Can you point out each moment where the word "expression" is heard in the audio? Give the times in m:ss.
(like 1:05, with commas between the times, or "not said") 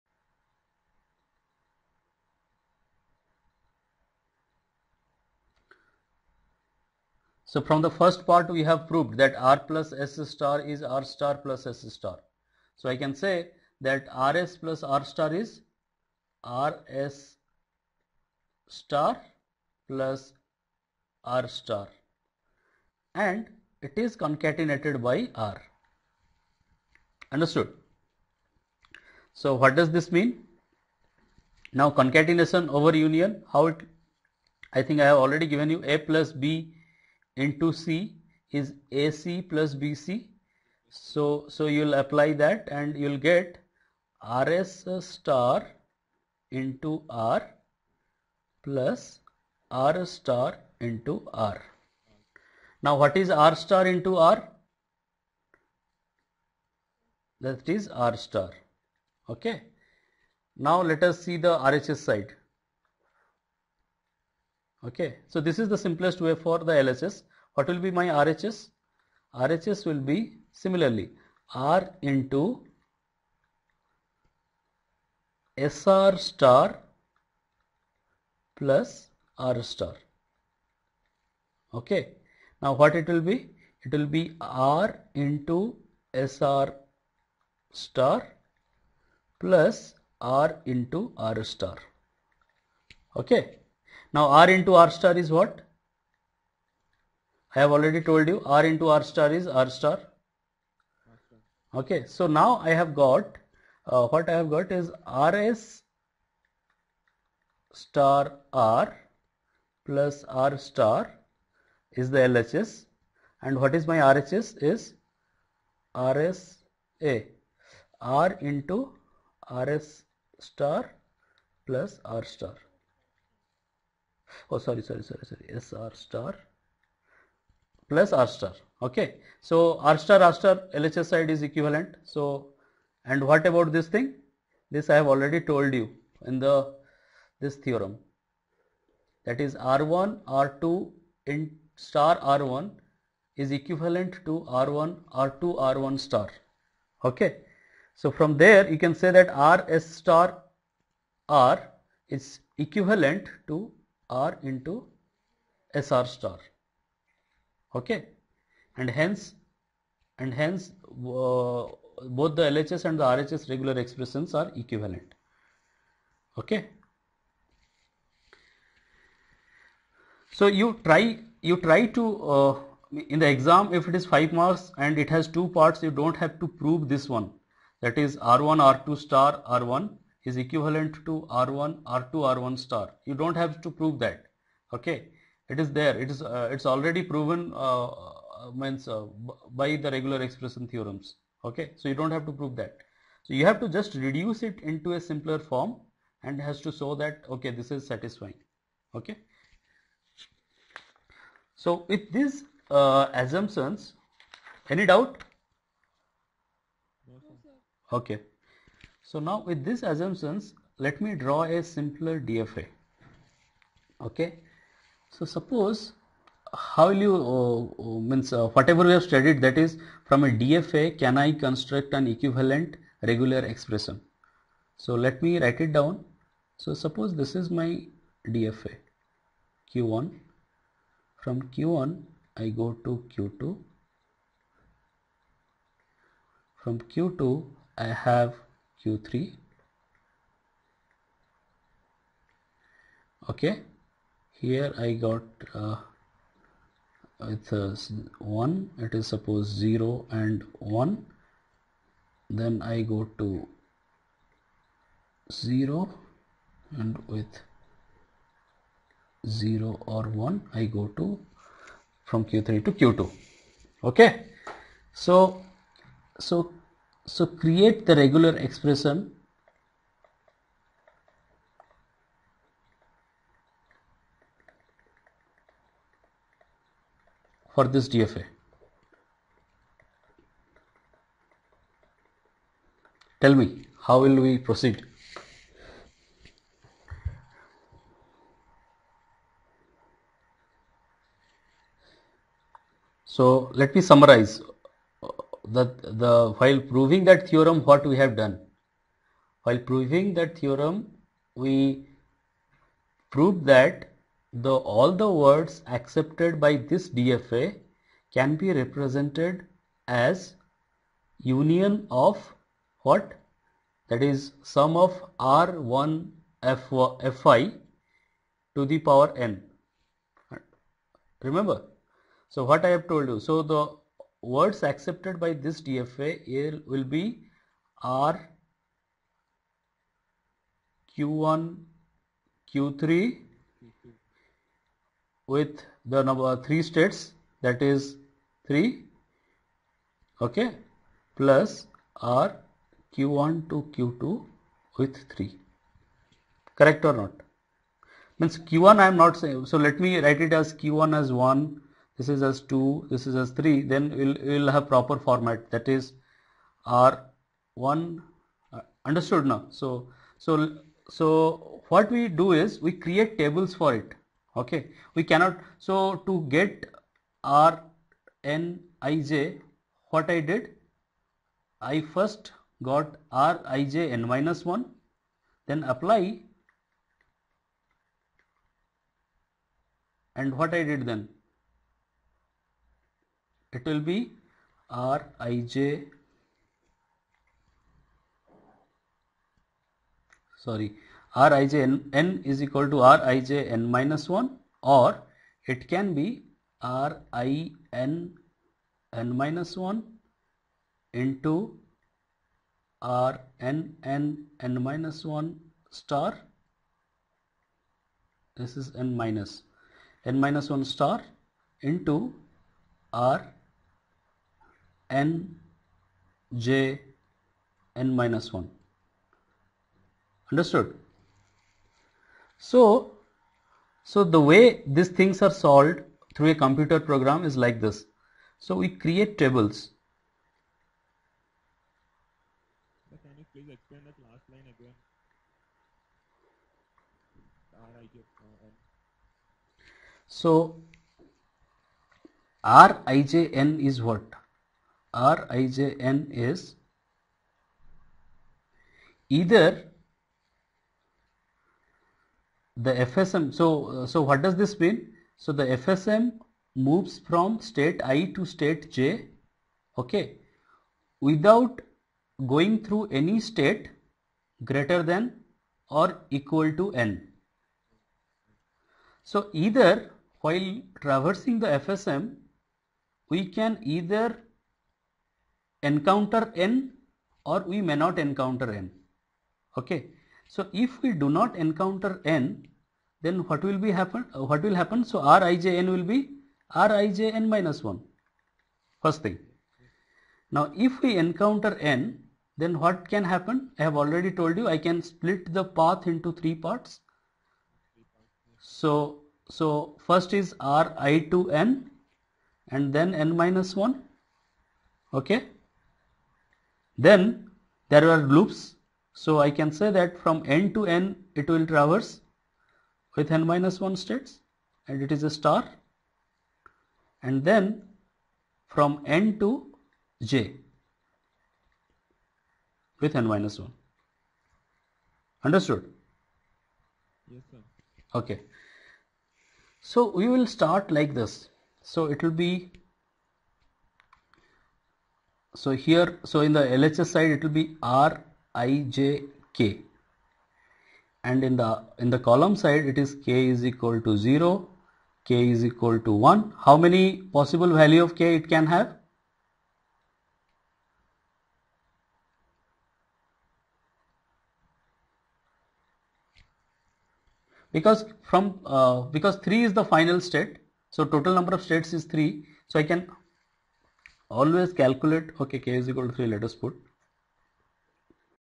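2:43, 3:10, 3:43, 4:28.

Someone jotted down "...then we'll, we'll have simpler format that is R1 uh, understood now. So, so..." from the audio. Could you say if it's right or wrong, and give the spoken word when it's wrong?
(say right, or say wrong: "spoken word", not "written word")
wrong: "proper", not "simpler".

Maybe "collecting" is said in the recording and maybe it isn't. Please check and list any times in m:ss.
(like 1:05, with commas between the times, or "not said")
not said.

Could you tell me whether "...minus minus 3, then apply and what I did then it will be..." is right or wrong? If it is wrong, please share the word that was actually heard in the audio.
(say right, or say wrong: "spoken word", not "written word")
wrong: "1", not "3".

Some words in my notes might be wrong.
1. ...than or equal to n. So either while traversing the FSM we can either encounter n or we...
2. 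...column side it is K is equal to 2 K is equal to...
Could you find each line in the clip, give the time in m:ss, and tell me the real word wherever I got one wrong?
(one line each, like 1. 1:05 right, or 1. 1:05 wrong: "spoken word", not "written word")
1. 7:44 right
2. 9:01 wrong: "0", not "2".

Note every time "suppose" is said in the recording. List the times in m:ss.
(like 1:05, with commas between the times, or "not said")
3:35, 3:46, 4:09.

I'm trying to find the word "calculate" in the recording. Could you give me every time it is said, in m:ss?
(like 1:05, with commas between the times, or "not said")
9:24.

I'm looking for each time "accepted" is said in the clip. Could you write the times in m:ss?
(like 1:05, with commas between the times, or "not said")
5:05, 5:24.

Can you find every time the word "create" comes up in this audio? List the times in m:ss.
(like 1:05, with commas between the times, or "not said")
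4:27, 6:02, 7:08.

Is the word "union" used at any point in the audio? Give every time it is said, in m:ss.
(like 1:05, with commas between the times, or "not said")
0:32, 5:11.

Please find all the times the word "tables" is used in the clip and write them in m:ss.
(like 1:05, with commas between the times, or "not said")
6:03, 7:09.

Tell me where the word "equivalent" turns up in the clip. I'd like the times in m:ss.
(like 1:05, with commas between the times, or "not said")
2:11, 2:23, 2:32, 2:44, 3:00, 3:42.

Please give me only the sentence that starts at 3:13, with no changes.
So you have to just reduce it into a simpler form and has to show that okay this is satisfying.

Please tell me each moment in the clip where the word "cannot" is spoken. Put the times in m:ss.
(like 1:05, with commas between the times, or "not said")
6:05.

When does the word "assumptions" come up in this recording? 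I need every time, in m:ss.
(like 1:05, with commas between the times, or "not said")
3:23, 3:29.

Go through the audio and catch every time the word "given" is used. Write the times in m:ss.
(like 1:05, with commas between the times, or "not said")
0:35.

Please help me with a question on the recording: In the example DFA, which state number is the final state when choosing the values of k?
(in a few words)
3.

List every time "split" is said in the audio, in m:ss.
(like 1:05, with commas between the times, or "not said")
8:14.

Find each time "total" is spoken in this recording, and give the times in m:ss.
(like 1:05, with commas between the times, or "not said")
9:20.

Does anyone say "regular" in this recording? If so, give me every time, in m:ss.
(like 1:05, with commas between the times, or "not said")
2:43, 3:09, 3:43, 4:27.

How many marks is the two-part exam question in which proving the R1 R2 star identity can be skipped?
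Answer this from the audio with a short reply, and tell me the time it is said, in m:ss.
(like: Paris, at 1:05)
5, at 2:54.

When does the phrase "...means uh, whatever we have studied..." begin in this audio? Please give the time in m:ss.
3:38.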